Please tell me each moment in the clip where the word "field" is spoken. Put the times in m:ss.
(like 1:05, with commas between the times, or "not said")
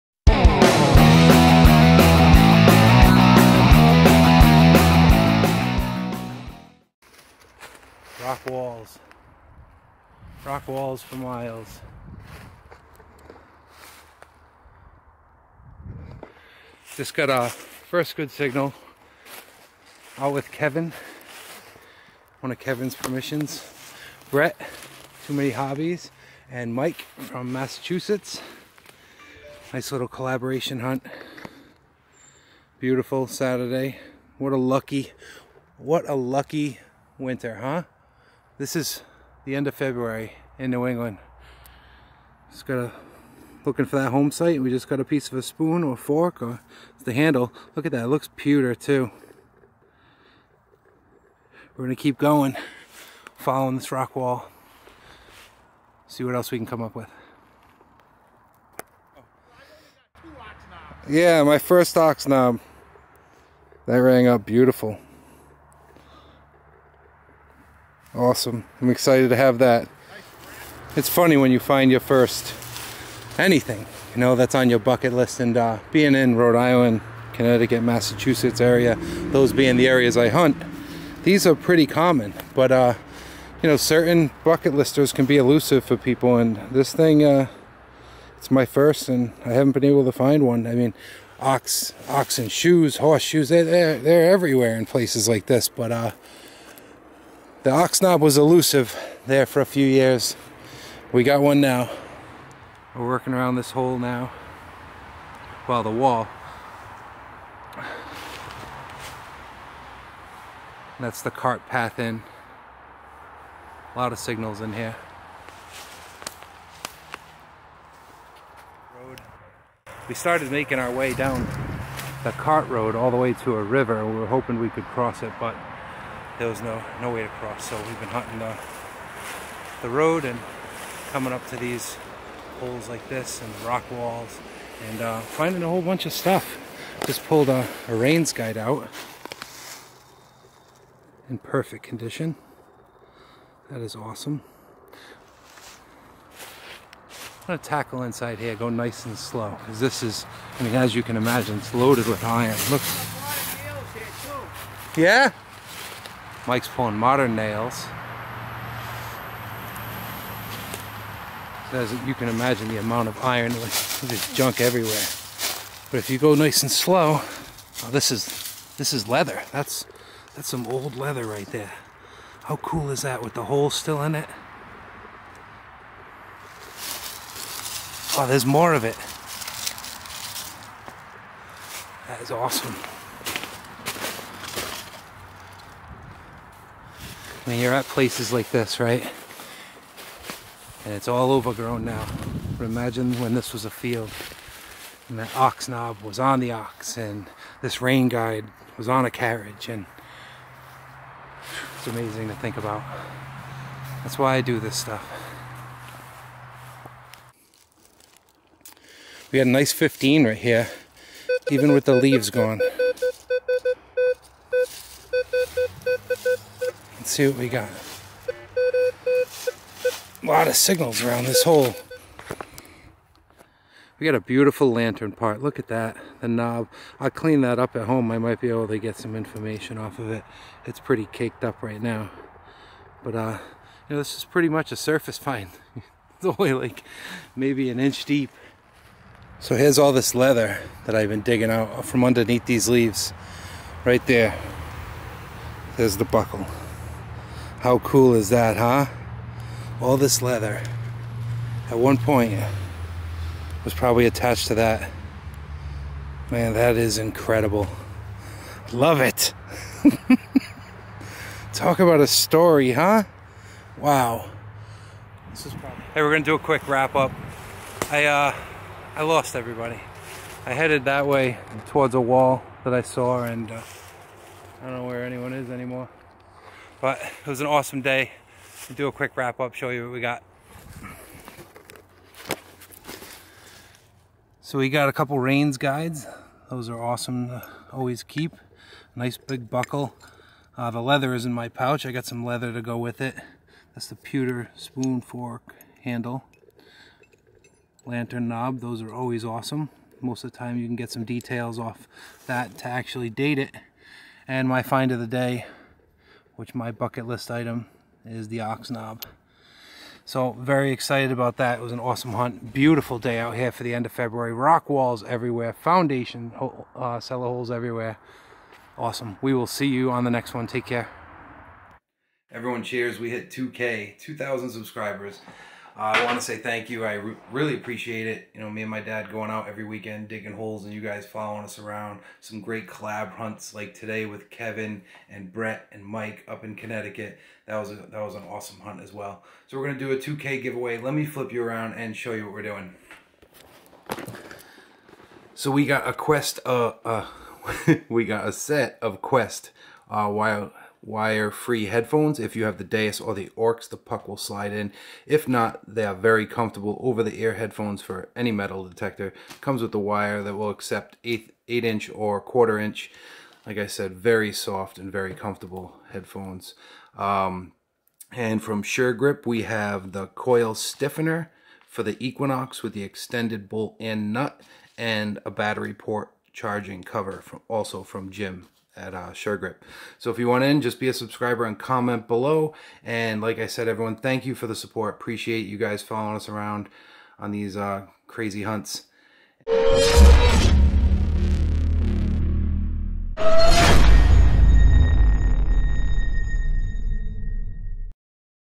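3:13.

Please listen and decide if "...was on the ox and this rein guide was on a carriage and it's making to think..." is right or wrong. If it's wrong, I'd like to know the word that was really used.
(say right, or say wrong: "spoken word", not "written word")
wrong: "amazing", not "making".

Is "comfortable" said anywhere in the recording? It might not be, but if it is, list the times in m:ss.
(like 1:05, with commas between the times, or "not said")
5:56, 6:05.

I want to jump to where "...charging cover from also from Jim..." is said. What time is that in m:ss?
6:16.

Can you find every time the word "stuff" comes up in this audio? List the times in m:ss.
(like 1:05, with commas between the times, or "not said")
2:16, 3:24.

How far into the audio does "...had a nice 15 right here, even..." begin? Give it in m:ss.
3:29.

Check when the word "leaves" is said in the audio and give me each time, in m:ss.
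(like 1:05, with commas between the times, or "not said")
3:31, 4:02.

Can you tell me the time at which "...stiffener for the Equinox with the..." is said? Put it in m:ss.
6:10.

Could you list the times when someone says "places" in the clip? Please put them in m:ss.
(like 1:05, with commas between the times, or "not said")
1:34, 3:07.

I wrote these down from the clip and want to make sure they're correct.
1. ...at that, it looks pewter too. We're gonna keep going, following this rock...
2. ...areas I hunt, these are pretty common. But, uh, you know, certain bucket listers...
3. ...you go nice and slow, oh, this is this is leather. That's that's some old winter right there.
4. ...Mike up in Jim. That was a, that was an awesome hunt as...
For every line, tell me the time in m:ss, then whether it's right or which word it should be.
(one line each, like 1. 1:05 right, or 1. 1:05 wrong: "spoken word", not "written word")
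1. 0:47 right
2. 1:19 right
3. 2:46 wrong: "leather", not "winter"
4. 5:35 wrong: "Connecticut", not "Jim".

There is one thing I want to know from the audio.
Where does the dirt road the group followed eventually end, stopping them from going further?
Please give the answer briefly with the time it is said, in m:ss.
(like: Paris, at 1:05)
a river, at 2:03.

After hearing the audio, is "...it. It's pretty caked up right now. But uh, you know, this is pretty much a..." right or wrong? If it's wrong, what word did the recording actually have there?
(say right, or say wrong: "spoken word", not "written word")
right.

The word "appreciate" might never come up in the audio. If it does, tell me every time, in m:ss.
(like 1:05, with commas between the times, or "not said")
5:27, 6:24.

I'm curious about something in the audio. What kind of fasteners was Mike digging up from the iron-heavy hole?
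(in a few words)
modern nails.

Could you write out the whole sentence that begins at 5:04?
And my find of the day which my bucket list item is the ox knob.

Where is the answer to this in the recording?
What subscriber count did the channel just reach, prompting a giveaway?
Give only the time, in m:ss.
5:23.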